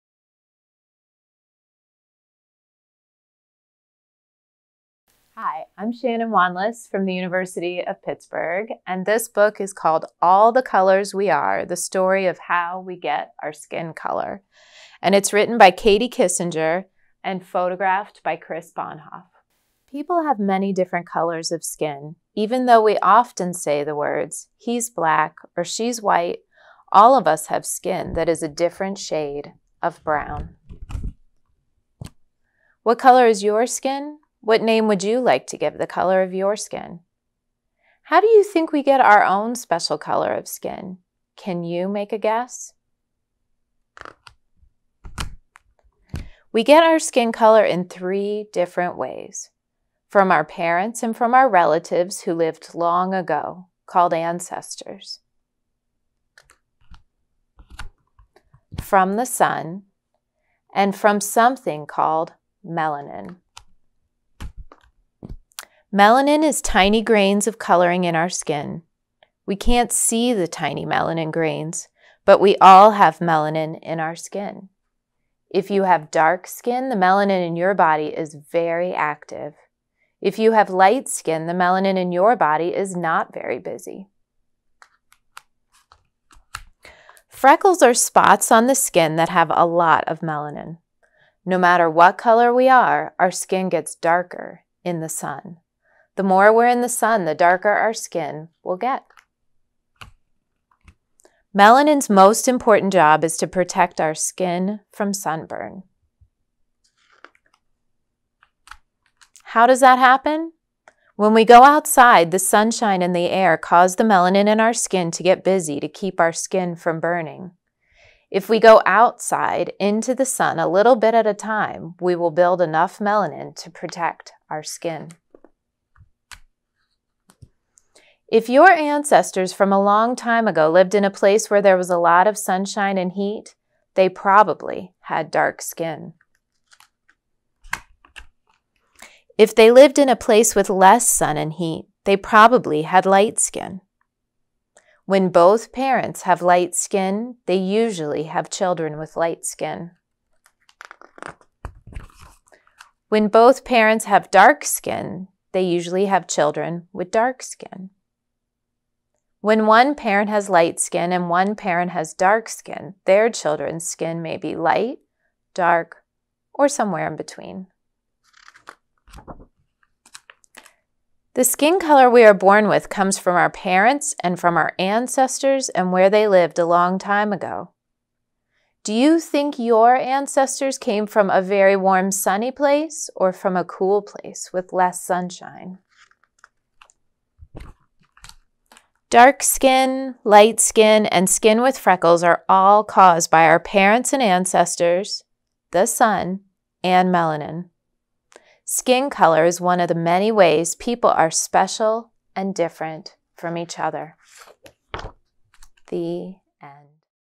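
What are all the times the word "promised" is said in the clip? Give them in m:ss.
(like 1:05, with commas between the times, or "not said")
not said.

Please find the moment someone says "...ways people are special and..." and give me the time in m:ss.
3:20.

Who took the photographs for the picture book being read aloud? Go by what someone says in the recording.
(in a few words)
Chris Bonhoff.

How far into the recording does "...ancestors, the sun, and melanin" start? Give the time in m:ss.
3:14.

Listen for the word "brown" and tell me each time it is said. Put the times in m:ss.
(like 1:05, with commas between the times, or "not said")
0:30.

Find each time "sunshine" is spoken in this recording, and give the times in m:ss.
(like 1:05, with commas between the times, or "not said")
1:52, 2:12, 3:05.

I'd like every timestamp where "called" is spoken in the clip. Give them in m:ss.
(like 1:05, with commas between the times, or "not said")
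0:09, 0:53, 1:01.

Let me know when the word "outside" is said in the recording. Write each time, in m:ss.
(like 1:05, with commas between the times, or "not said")
1:51, 1:58.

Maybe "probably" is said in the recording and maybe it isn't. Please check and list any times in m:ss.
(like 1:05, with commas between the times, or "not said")
2:14, 2:22.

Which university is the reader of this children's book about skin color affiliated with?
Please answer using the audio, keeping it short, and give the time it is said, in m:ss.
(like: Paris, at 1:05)
University of Pittsburgh, at 0:07.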